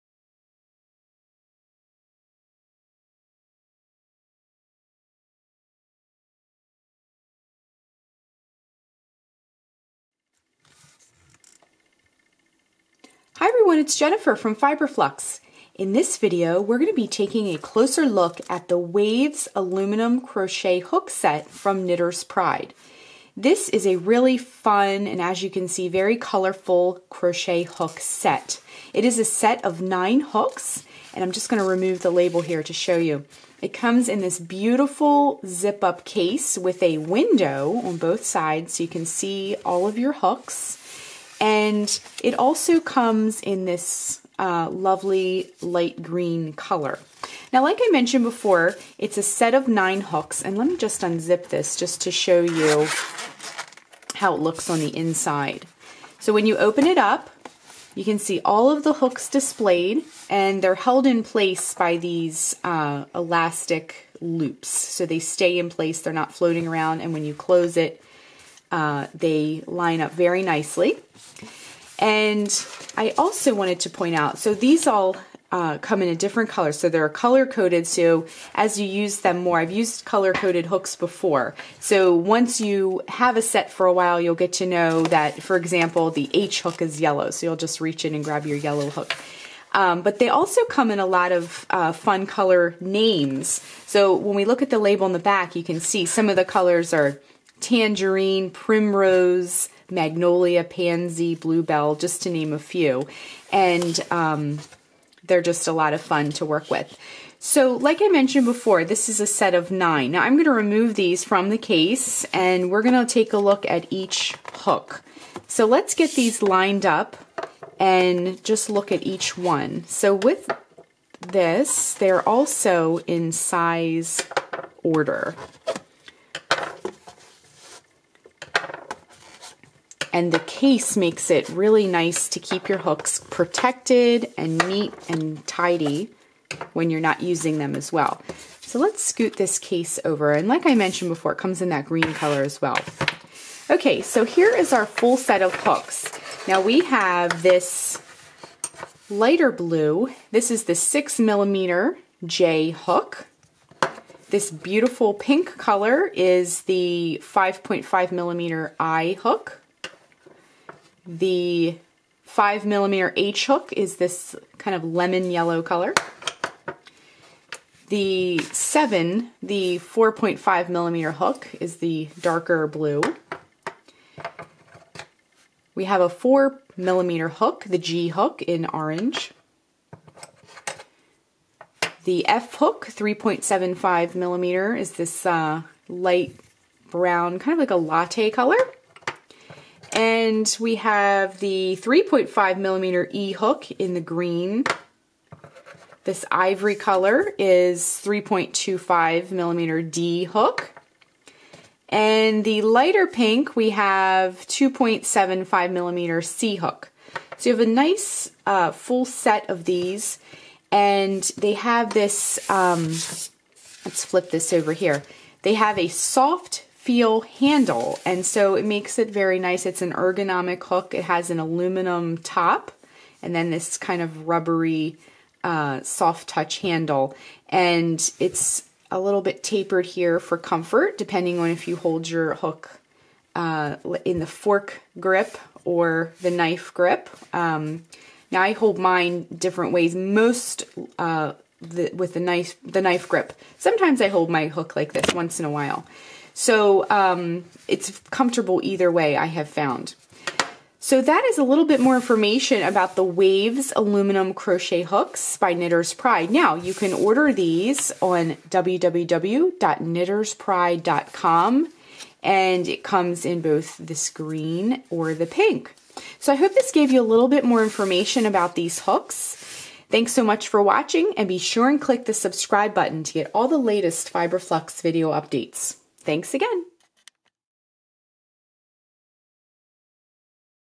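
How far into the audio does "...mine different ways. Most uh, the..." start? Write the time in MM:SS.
03:58.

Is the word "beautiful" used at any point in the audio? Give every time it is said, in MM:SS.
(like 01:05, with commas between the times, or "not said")
00:34, 02:34.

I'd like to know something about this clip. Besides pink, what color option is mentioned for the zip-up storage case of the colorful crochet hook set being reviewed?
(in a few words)
light green.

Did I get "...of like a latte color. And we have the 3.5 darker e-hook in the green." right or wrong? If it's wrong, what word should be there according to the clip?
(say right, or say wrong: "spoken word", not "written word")
wrong: "millimeter", not "darker".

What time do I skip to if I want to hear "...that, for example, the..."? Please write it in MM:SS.
01:25.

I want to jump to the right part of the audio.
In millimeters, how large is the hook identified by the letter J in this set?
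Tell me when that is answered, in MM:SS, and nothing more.
02:30.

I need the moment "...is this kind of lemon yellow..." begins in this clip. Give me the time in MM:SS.
02:43.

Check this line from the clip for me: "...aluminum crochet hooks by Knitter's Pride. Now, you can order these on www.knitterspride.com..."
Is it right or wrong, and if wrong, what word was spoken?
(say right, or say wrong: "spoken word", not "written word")
right.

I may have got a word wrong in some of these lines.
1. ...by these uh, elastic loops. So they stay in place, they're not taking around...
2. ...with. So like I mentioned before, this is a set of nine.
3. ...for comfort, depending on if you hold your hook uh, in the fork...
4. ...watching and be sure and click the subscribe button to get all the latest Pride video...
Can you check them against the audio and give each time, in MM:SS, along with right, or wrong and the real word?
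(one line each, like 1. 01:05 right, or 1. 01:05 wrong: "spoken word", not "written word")
1. 01:01 wrong: "floating", not "taking"
2. 01:46 right
3. 03:50 right
4. 04:30 wrong: "Fiberflux", not "Pride".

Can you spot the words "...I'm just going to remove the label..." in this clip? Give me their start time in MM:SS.
00:31.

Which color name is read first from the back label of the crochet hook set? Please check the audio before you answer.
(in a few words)
tangerine.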